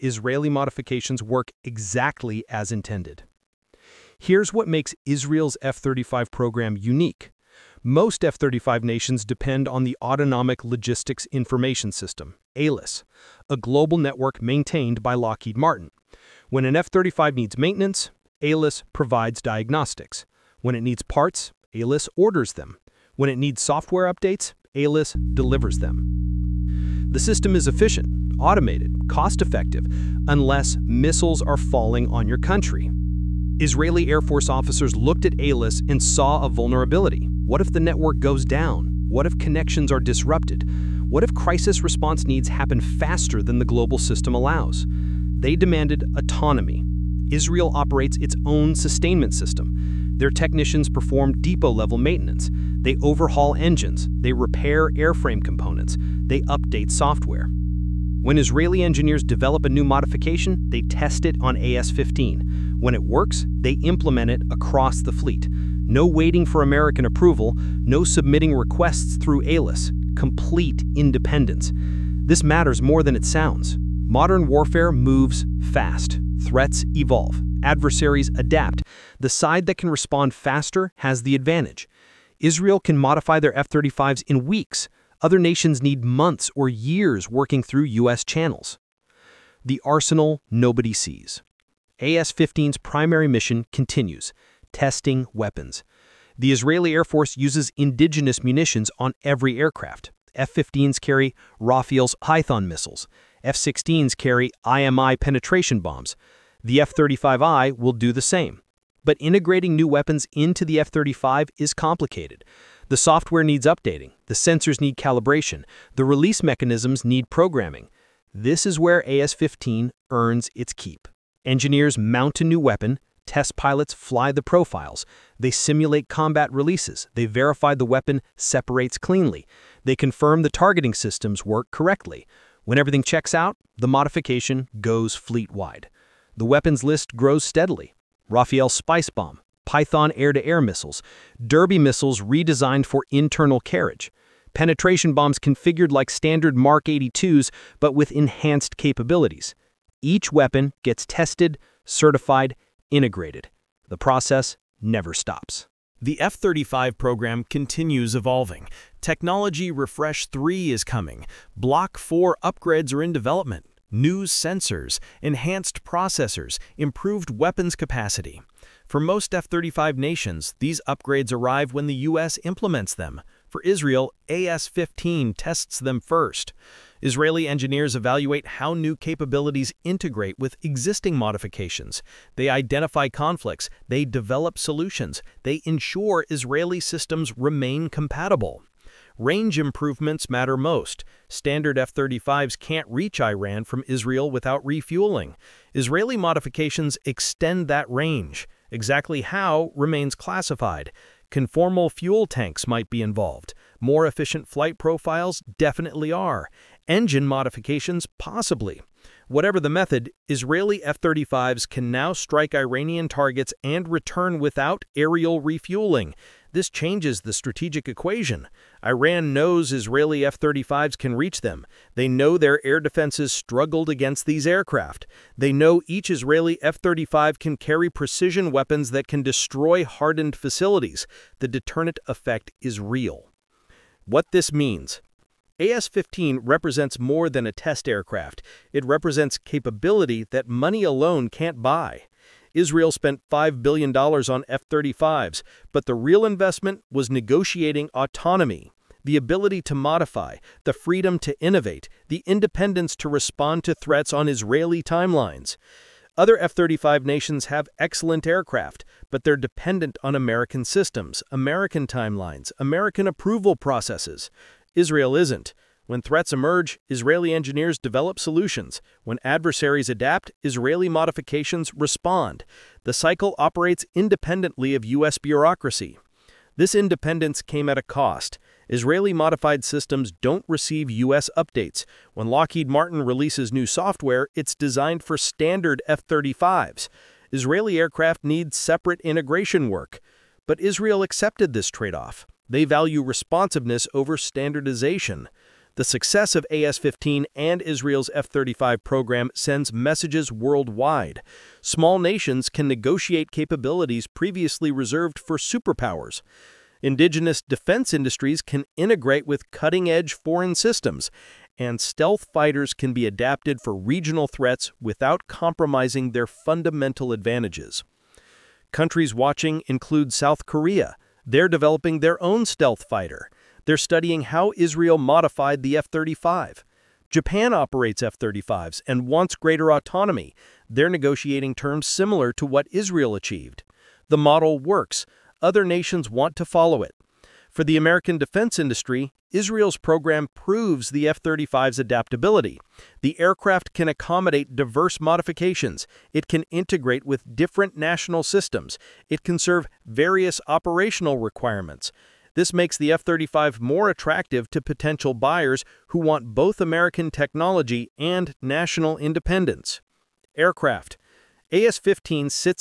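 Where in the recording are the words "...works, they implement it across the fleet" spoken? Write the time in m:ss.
1:03.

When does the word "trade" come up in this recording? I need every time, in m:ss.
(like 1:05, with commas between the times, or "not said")
4:51.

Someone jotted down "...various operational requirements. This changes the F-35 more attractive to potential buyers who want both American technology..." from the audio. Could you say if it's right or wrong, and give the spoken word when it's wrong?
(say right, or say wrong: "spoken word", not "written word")
wrong: "makes", not "changes".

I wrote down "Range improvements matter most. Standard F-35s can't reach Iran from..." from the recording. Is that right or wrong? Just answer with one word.
right.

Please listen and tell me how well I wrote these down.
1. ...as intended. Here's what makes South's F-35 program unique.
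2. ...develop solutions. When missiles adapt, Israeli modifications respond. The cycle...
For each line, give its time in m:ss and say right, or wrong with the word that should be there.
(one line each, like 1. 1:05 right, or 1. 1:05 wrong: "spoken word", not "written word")
1. 0:02 wrong: "Israel", not "South"
2. 4:27 wrong: "adversaries", not "missiles".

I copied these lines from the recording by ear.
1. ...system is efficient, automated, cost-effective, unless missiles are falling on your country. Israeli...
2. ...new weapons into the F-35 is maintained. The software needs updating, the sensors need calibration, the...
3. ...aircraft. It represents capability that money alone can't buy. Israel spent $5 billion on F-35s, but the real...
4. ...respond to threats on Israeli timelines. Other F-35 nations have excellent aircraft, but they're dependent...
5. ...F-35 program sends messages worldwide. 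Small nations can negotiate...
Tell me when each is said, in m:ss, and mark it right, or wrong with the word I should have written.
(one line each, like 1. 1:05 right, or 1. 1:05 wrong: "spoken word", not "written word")
1. 0:27 right
2. 1:49 wrong: "complicated", not "maintained"
3. 3:57 right
4. 4:13 right
5. 4:58 right.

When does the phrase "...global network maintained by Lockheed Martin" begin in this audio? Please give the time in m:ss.
0:13.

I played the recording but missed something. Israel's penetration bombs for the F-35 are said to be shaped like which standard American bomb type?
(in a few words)
Mark 82.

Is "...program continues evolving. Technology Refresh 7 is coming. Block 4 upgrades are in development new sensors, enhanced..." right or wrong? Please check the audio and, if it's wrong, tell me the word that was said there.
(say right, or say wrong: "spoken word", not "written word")
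wrong: "3", not "7".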